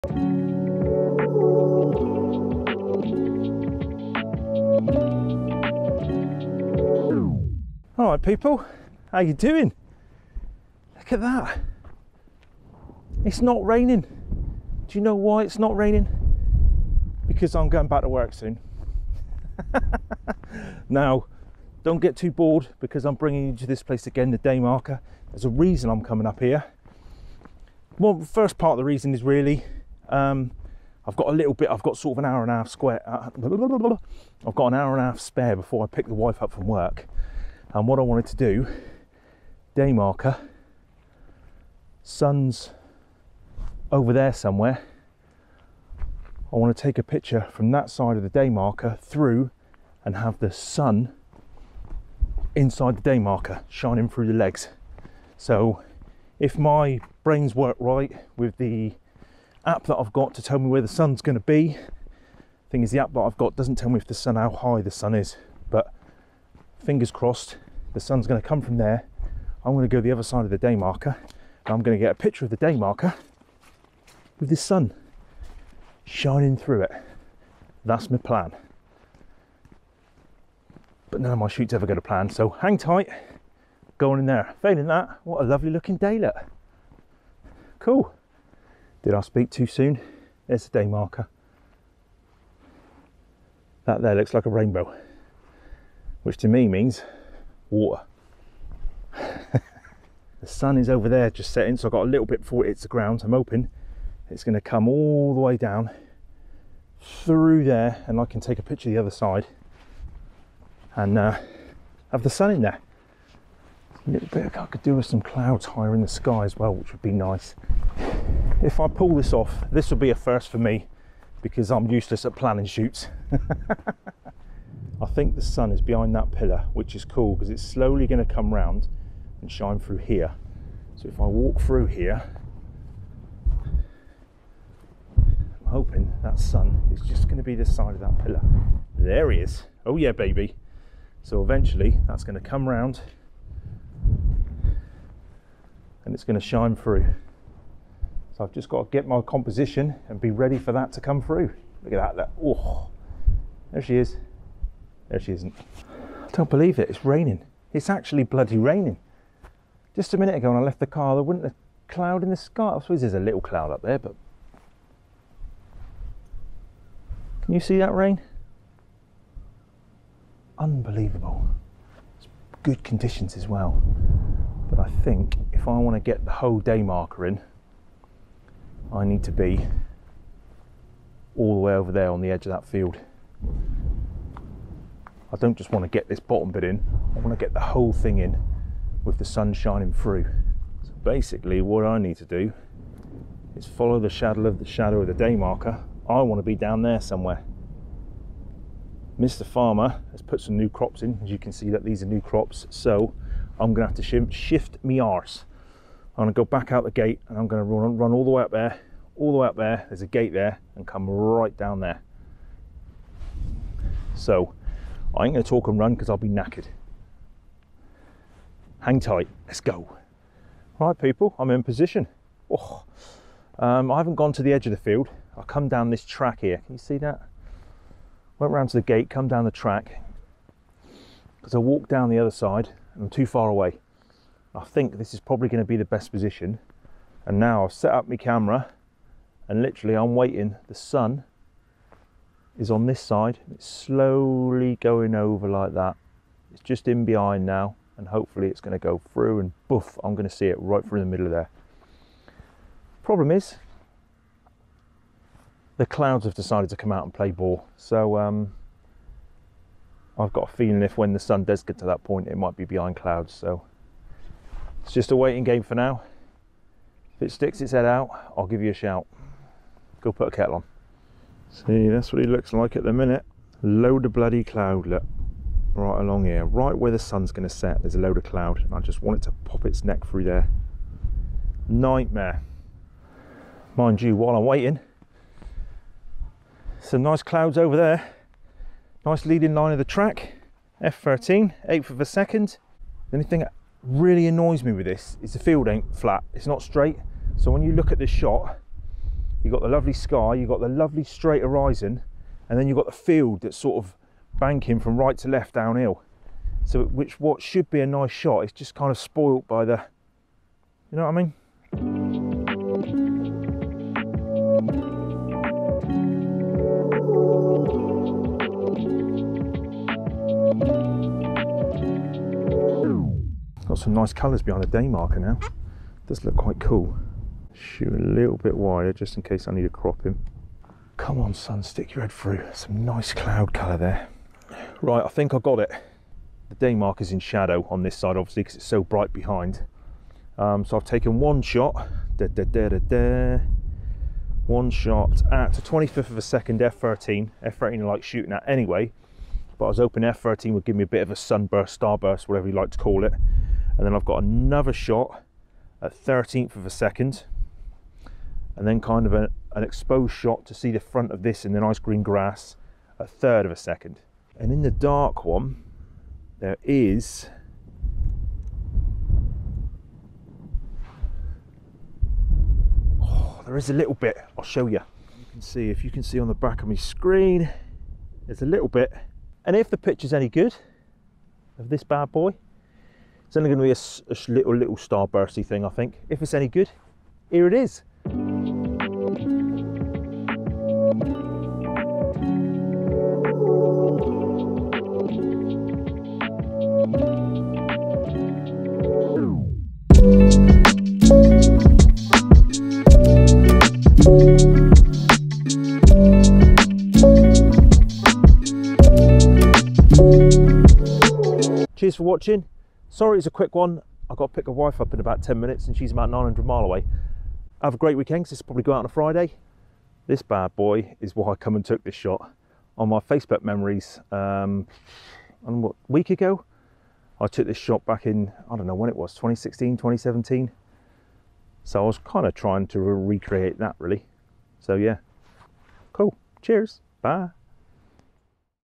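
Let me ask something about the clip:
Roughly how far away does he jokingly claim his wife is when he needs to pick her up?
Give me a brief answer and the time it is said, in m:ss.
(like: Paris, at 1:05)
900 miles, at 6:56.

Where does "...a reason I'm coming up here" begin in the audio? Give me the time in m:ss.
0:25.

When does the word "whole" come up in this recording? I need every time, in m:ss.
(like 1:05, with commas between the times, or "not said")
2:56, 3:07.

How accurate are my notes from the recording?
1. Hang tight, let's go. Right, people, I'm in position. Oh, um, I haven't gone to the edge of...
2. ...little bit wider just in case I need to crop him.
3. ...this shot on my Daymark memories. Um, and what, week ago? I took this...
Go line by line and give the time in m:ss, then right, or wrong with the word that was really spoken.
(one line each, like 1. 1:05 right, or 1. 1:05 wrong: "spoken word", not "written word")
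1. 3:38 right
2. 5:28 right
3. 7:01 wrong: "Facebook", not "Daymark".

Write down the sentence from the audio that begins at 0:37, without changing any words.
And what I wanted to do, day marker, sun's over there somewhere.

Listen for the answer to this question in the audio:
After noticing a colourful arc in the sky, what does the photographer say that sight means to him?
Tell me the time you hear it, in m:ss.
1:37.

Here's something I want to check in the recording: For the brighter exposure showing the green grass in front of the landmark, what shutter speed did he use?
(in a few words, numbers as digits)
a third of a second.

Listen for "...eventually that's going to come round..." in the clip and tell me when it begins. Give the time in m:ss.
2:21.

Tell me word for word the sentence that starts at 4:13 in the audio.
Problem is, the clouds have decided to come out and play ball.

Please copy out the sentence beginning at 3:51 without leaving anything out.
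Because I walked down the other side and I'm too far away.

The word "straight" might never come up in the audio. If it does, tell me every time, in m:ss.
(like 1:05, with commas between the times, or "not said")
4:56, 5:01.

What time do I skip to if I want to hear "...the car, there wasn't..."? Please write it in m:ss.
2:40.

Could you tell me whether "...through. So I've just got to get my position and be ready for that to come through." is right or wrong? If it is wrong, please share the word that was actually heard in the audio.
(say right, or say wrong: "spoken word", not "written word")
wrong: "composition", not "position".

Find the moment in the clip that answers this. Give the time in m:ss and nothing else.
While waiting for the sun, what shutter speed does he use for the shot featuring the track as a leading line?
4:51.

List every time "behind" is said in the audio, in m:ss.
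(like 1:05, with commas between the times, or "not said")
2:05, 4:07, 4:22, 5:24, 5:39.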